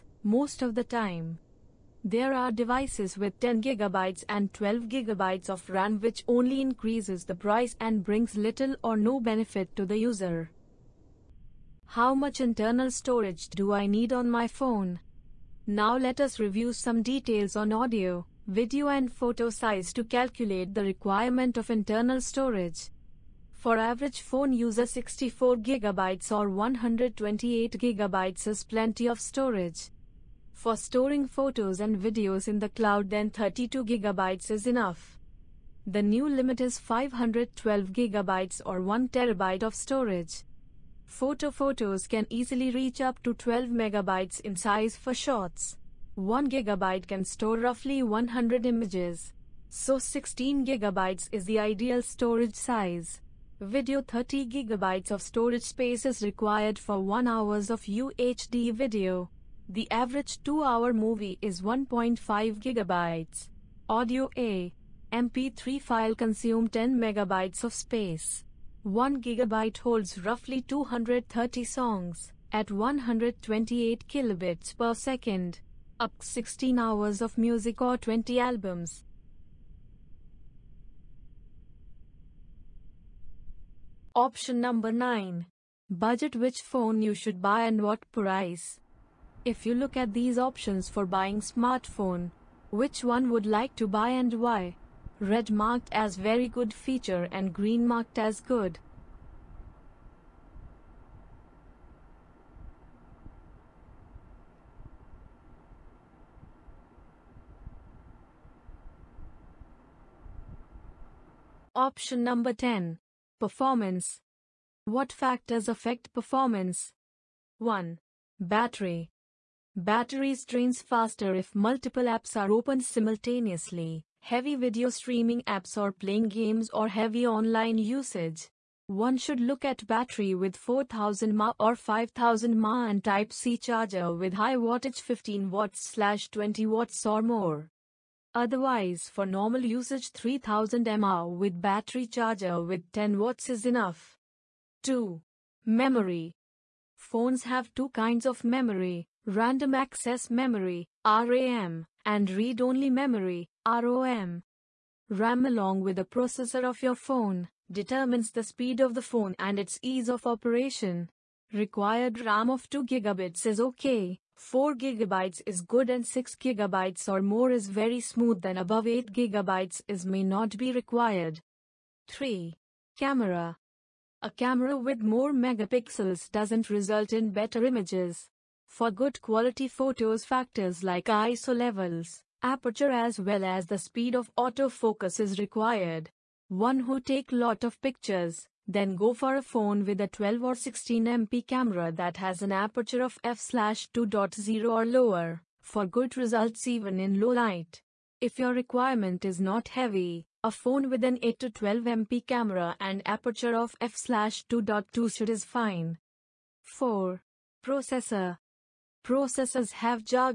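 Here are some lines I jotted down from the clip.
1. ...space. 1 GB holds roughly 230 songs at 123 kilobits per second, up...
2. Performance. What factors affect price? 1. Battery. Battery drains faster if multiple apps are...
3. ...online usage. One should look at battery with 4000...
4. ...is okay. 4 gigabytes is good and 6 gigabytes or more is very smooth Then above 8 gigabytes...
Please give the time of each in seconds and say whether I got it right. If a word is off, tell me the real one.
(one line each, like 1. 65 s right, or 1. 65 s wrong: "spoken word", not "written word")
1. 67 s wrong: "128", not "123"
2. 113 s wrong: "performance", not "price"
3. 127 s right
4. 163 s right.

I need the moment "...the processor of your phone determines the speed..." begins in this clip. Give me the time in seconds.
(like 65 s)
155 s.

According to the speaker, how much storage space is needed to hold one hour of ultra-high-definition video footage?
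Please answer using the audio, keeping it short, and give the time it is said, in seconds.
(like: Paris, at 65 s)
30 GB, at 54 s.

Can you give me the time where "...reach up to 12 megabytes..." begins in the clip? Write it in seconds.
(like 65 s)
42 s.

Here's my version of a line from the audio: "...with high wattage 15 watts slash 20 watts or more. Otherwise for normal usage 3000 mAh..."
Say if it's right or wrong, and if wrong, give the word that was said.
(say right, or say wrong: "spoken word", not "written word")
right.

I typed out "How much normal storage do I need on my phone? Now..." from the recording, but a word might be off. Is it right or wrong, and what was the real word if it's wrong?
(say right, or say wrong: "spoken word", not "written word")
wrong: "internal", not "normal".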